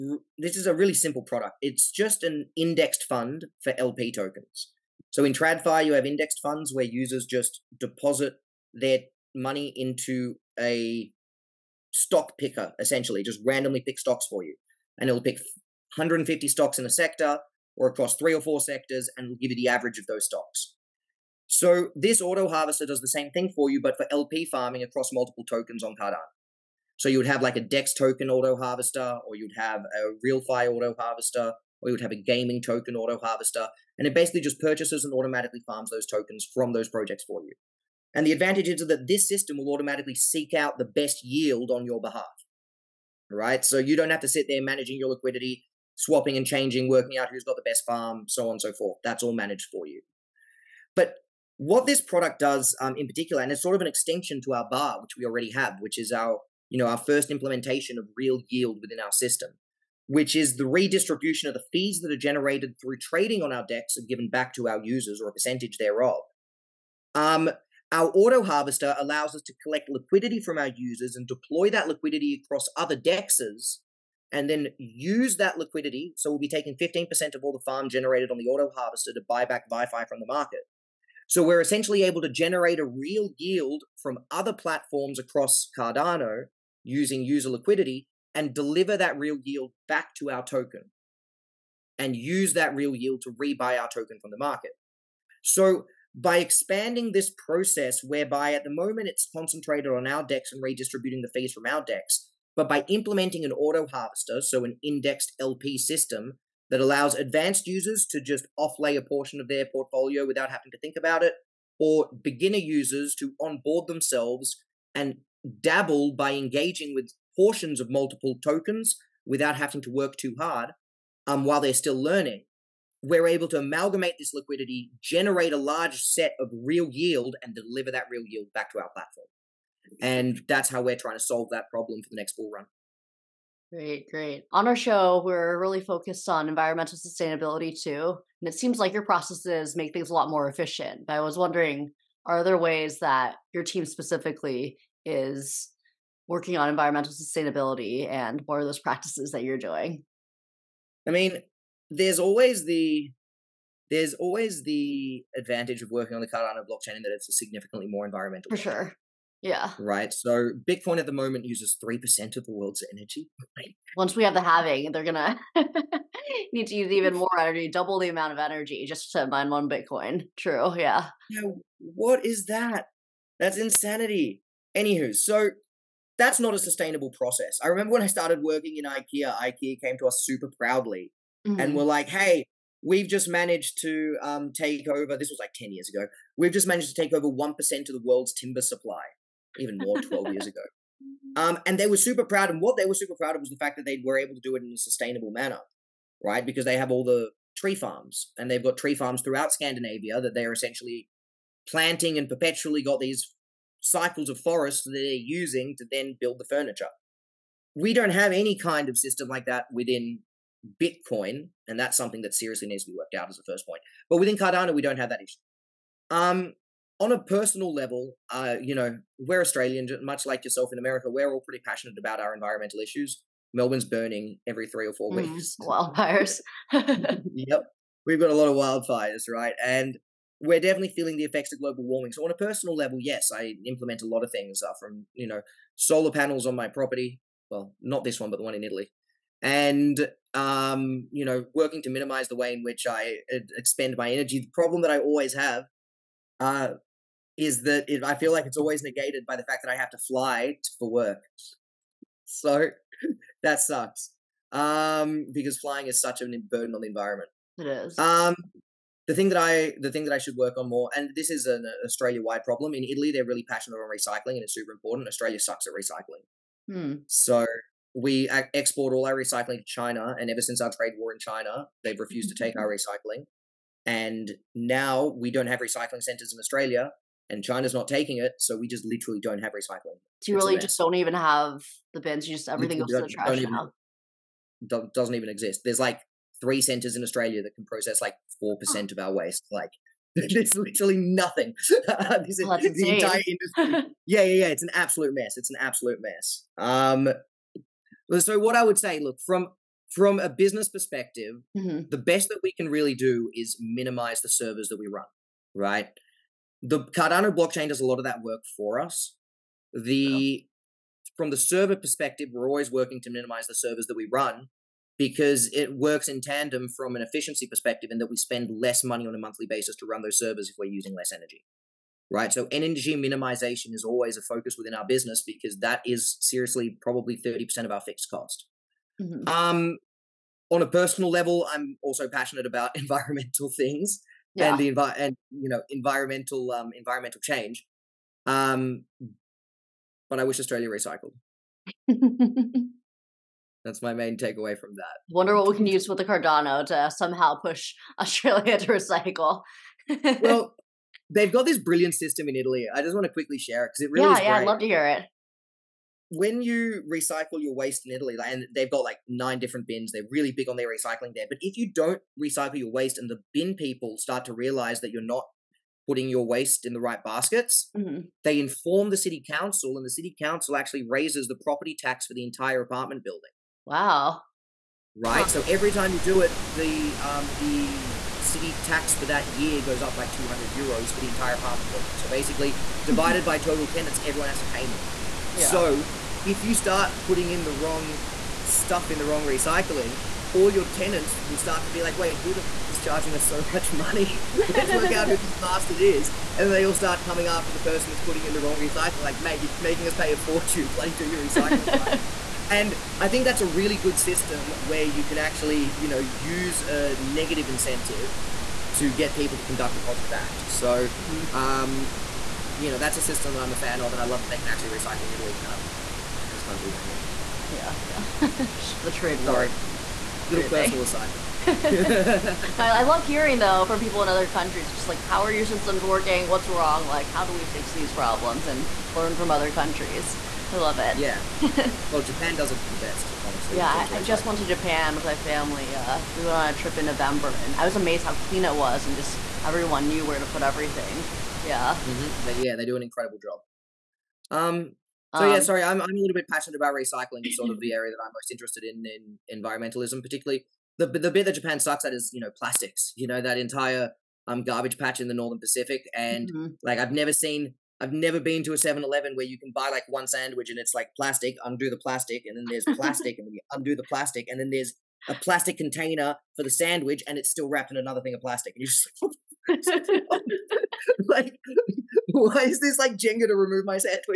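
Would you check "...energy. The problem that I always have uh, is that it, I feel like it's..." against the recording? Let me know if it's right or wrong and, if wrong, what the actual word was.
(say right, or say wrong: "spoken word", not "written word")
right.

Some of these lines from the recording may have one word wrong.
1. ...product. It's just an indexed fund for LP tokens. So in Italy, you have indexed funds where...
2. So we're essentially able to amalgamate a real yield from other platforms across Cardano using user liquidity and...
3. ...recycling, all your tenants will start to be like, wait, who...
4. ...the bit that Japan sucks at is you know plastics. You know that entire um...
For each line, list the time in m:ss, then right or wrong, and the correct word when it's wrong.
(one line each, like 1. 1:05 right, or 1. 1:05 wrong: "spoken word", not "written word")
1. 0:01 wrong: "TradFi", not "Italy"
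2. 1:21 wrong: "generate", not "amalgamate"
3. 6:29 right
4. 7:30 right.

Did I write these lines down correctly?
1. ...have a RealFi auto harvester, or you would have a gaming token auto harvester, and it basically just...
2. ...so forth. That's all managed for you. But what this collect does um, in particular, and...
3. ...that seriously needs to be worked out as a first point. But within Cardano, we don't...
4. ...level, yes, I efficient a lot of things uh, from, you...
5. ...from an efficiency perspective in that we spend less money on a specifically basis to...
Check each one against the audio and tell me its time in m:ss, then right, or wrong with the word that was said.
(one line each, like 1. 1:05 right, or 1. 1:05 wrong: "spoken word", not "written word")
1. 0:29 right
2. 0:48 wrong: "product", not "collect"
3. 3:32 right
4. 3:52 wrong: "implement", not "efficient"
5. 5:16 wrong: "monthly", not "specifically".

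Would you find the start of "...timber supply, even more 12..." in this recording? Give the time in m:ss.
3:08.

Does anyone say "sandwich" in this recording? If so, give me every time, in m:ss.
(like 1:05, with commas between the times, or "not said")
7:40, 7:46.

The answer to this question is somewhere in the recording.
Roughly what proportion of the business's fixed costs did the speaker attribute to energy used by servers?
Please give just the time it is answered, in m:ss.
5:27.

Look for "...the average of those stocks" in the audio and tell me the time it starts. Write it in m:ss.
0:19.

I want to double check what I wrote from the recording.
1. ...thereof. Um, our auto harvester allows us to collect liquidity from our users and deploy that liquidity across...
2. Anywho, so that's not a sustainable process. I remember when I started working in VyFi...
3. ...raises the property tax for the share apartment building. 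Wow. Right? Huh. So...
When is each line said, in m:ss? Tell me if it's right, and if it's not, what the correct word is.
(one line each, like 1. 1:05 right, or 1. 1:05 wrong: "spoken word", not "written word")
1. 1:05 right
2. 2:54 wrong: "IKEA", not "VyFi"
3. 6:10 wrong: "entire", not "share".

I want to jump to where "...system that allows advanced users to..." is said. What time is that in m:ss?
1:45.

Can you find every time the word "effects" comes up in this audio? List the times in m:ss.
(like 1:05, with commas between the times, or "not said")
3:51.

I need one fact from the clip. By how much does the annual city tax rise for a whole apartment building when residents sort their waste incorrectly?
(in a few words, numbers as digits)
200 euros.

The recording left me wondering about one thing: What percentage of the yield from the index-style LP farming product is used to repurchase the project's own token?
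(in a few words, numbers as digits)
15%.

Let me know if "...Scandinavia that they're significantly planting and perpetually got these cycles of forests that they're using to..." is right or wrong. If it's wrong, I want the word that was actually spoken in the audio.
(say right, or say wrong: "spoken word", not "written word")
wrong: "essentially", not "significantly".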